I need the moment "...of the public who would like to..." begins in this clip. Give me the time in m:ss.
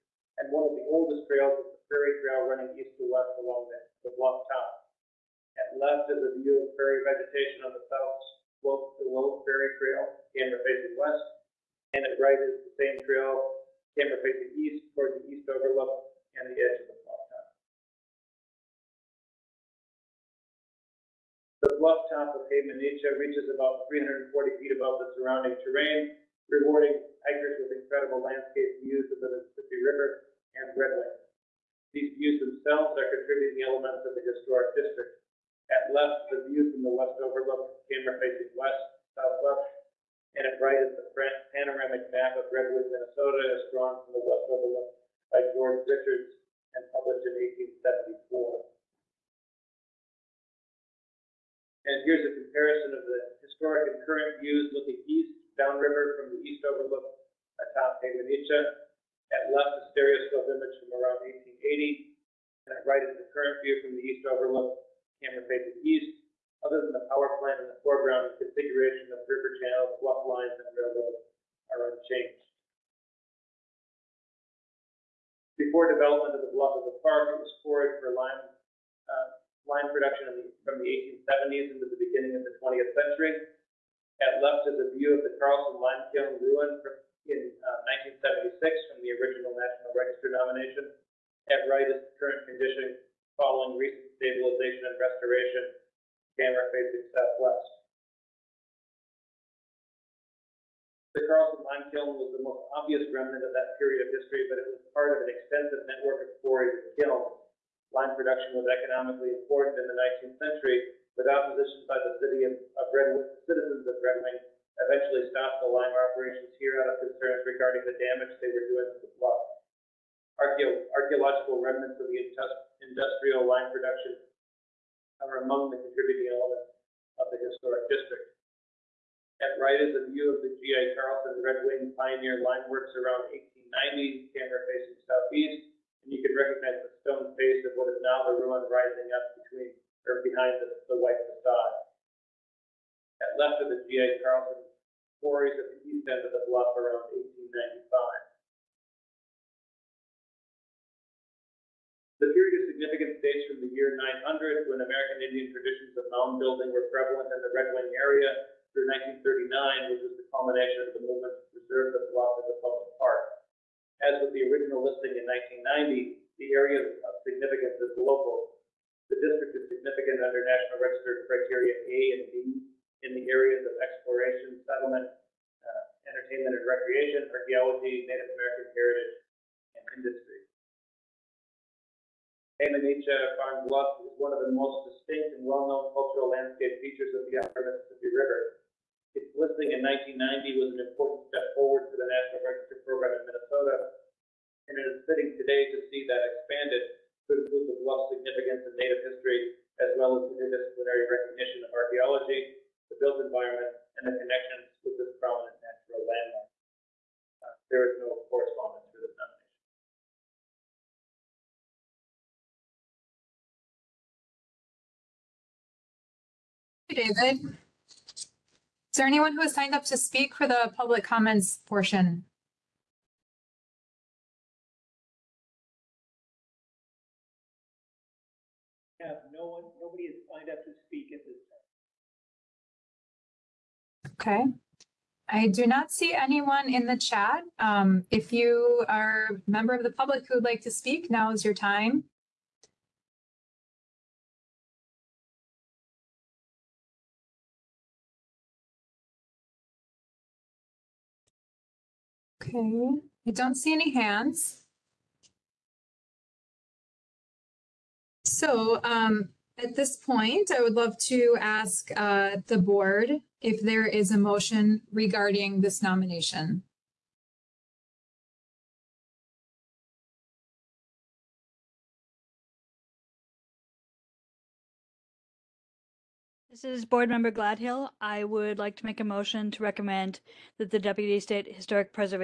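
3:59.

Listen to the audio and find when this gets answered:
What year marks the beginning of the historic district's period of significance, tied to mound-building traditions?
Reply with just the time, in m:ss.
2:34.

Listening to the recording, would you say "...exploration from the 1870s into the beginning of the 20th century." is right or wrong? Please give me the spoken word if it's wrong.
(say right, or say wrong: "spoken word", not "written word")
wrong: "production", not "exploration".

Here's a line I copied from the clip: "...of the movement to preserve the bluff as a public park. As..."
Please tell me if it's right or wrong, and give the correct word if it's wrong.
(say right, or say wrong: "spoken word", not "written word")
right.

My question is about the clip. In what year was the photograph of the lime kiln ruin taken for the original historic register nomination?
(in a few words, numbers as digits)
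1976.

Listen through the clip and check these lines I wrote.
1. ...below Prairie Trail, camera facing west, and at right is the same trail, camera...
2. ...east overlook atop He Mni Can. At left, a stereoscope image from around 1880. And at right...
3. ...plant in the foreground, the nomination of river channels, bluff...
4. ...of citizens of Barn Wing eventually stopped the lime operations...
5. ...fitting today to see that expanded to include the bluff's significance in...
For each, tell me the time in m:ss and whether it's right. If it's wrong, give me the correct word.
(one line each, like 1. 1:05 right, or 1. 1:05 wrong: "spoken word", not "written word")
1. 0:09 right
2. 0:56 right
3. 1:07 wrong: "configuration", not "nomination"
4. 1:52 wrong: "Red", not "Barn"
5. 3:15 right.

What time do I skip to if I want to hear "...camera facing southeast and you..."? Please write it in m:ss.
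2:14.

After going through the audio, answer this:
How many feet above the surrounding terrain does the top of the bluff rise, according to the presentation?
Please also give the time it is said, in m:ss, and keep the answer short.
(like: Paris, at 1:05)
340 feet, at 0:23.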